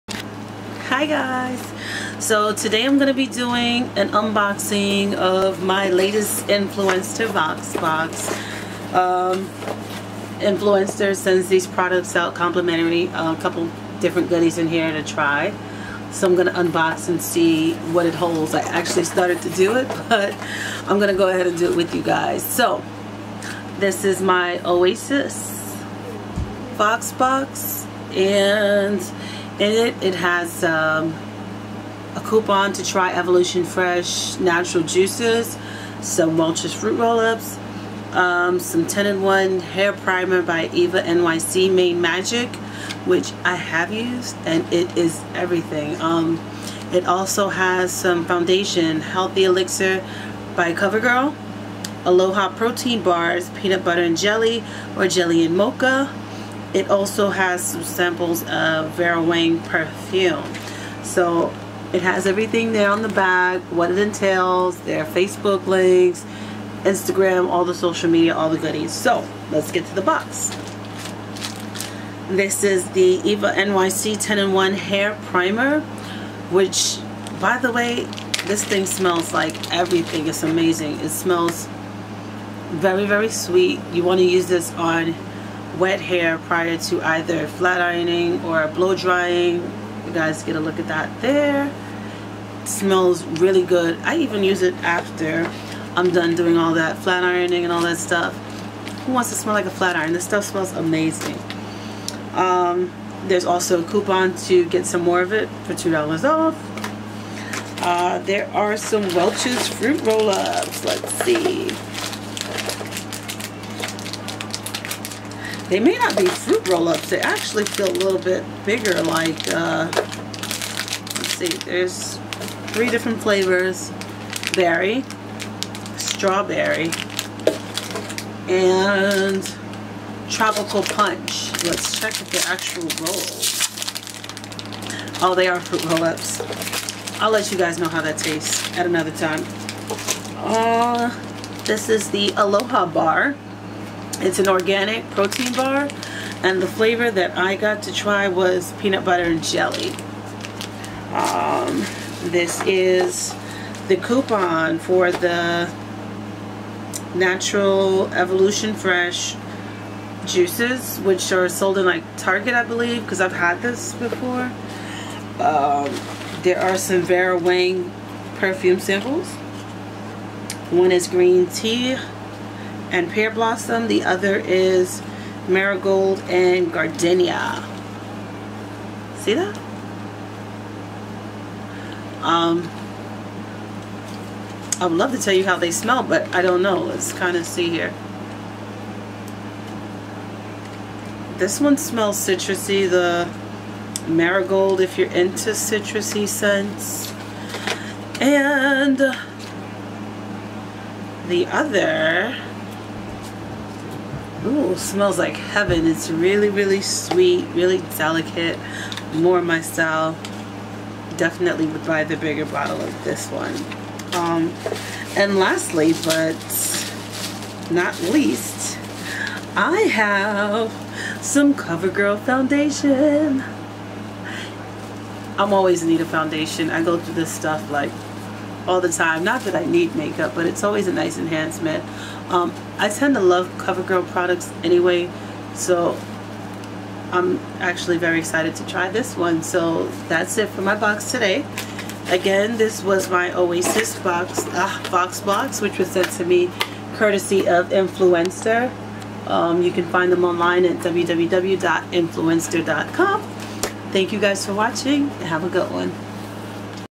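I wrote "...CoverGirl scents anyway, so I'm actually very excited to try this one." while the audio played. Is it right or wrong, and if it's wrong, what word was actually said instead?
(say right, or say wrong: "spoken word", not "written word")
wrong: "products", not "scents".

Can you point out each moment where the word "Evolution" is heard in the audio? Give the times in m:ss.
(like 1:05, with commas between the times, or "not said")
0:33, 2:38.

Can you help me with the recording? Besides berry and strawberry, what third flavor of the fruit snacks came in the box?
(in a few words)
Tropical punch.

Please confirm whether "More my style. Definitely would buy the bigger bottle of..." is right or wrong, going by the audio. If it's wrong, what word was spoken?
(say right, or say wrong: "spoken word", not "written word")
right.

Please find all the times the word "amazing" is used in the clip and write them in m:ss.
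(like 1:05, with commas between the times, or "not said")
1:20, 1:40.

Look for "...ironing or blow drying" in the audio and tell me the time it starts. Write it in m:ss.
1:27.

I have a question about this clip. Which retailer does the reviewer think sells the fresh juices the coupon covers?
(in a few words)
Target.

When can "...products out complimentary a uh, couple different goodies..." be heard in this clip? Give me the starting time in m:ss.
0:11.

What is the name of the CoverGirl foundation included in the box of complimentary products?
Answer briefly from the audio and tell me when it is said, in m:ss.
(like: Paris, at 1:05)
Healthy Elixir, at 0:48.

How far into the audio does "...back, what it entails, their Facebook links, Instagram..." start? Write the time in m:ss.
1:03.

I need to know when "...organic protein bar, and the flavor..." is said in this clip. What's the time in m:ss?
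2:24.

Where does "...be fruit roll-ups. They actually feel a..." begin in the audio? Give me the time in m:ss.
1:56.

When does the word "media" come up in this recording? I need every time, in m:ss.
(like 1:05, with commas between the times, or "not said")
1:08.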